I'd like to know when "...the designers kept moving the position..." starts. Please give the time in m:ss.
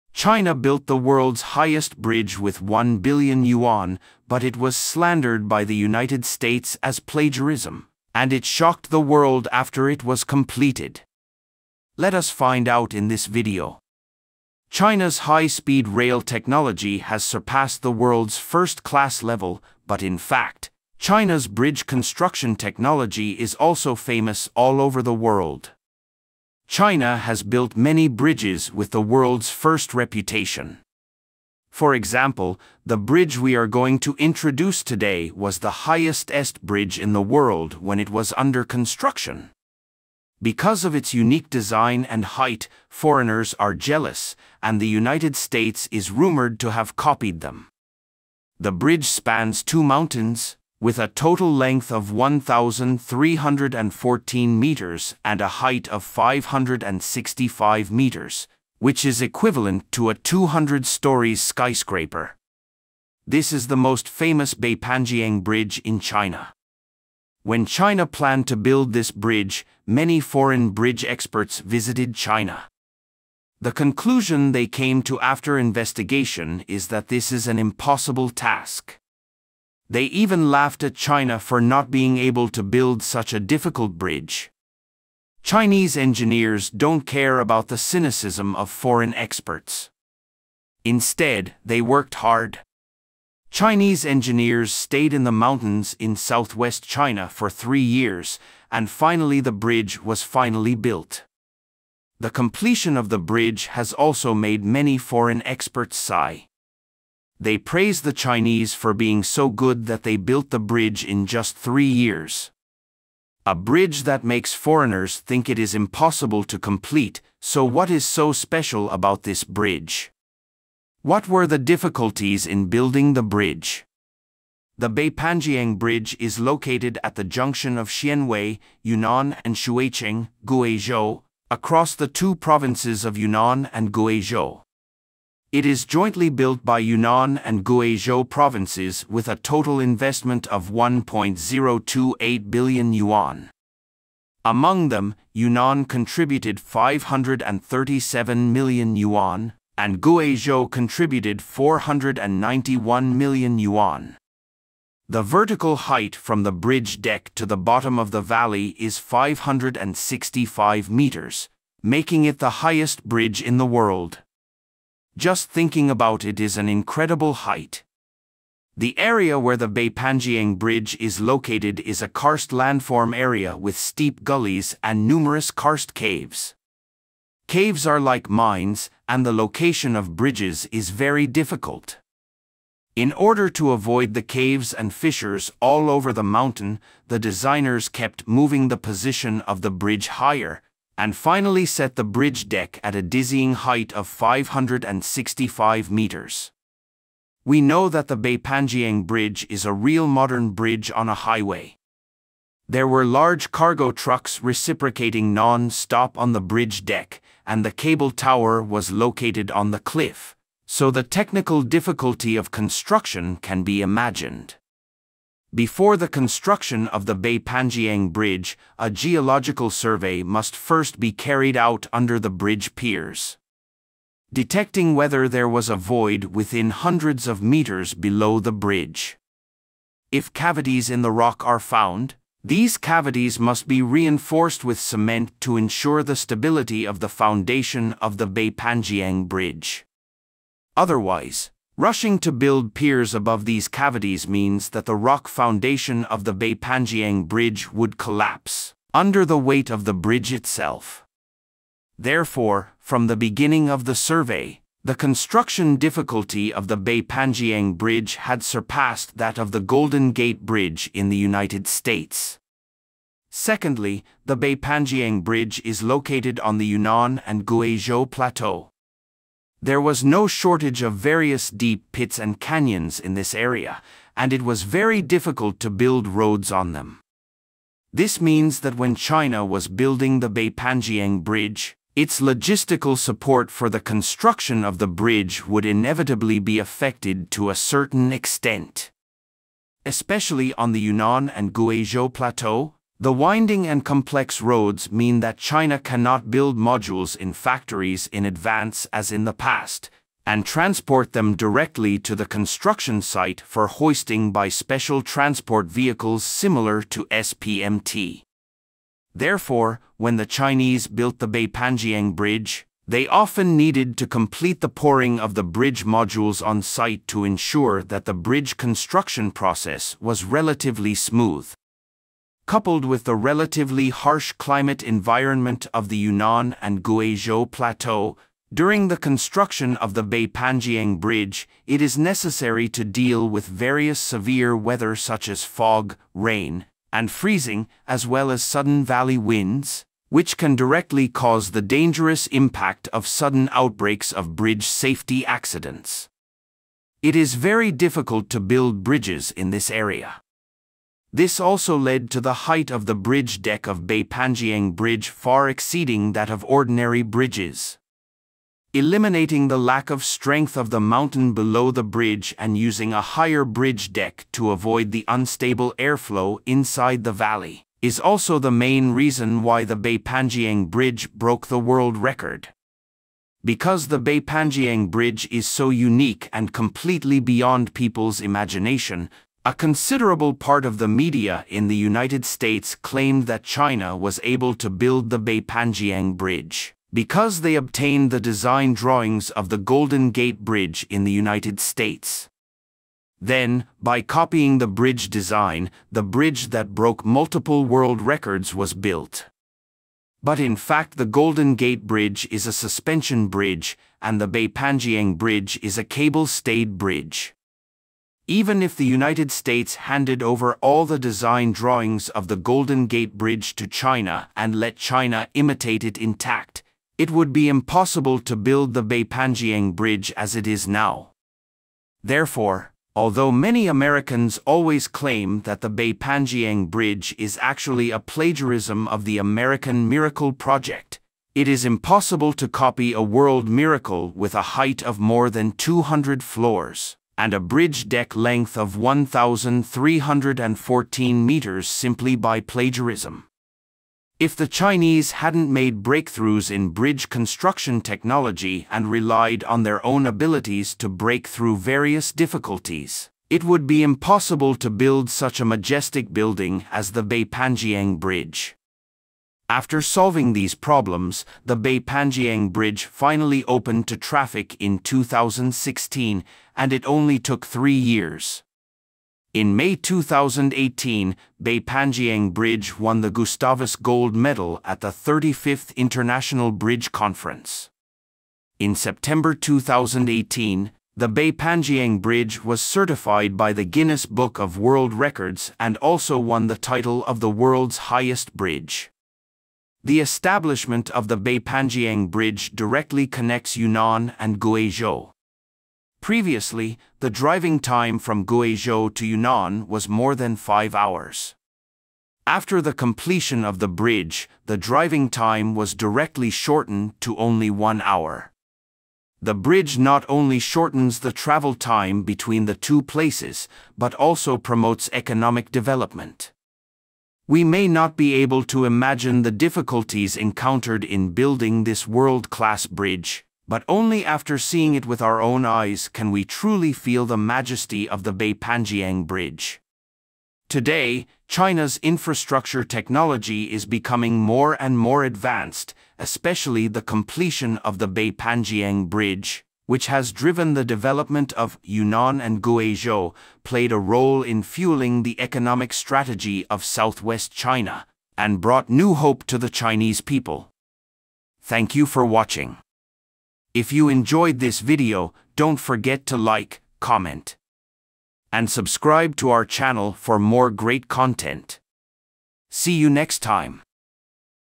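3:07.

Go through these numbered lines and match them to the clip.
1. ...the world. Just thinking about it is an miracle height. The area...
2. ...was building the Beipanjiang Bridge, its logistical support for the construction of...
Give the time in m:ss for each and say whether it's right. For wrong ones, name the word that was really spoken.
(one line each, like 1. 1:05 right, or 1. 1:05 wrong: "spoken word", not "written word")
1. 2:43 wrong: "incredible", not "miracle"
2. 4:39 right.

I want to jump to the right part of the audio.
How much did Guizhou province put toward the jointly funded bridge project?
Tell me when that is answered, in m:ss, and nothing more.
2:31.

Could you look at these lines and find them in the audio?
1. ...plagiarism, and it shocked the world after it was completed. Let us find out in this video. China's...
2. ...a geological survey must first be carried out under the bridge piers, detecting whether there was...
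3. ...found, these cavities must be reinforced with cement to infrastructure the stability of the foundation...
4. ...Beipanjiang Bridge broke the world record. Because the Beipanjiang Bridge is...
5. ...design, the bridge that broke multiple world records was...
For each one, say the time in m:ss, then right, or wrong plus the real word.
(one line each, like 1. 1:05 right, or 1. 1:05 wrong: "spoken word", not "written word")
1. 0:06 right
2. 3:38 right
3. 3:51 wrong: "ensure", not "infrastructure"
4. 6:09 right
5. 6:35 right.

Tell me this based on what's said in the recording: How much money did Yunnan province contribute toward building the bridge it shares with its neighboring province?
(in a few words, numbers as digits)
537 million yuan.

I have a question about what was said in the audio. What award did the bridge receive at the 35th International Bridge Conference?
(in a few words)
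Gustavus Gold Medal.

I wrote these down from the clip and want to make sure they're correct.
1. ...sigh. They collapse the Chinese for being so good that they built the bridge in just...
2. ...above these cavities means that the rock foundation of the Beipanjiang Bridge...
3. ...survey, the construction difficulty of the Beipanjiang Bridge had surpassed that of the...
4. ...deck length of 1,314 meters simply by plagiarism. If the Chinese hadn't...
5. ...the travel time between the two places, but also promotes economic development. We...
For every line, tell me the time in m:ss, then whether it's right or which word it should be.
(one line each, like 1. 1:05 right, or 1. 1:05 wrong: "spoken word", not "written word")
1. 1:45 wrong: "praise", not "collapse"
2. 4:03 right
3. 4:13 right
4. 7:17 right
5. 8:30 right.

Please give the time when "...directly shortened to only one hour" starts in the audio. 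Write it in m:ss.
8:25.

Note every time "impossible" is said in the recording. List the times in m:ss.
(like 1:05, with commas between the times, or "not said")
1:17, 1:55, 6:57, 7:11, 7:33.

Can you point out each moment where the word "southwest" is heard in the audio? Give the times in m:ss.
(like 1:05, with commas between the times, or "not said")
1:36, 9:06.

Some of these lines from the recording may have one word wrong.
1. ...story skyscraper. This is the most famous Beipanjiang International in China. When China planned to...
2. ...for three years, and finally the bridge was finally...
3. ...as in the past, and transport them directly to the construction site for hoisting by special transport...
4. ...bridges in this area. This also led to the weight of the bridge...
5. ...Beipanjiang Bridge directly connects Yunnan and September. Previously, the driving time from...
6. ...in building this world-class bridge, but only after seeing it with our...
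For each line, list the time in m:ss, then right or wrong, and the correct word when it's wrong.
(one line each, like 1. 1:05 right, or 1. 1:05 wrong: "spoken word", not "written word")
1. 1:00 wrong: "Bridge", not "International"
2. 1:37 right
3. 4:58 right
4. 5:48 wrong: "height", not "weight"
5. 8:11 wrong: "Guizhou", not "September"
6. 8:40 right.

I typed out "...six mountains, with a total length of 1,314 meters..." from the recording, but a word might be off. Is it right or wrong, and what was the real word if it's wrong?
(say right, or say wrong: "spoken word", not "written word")
wrong: "two", not "six".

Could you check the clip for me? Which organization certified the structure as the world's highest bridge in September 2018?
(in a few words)
Guinness Book of World Records.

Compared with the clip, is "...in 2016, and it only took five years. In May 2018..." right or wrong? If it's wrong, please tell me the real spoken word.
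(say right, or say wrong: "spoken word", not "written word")
wrong: "three", not "five".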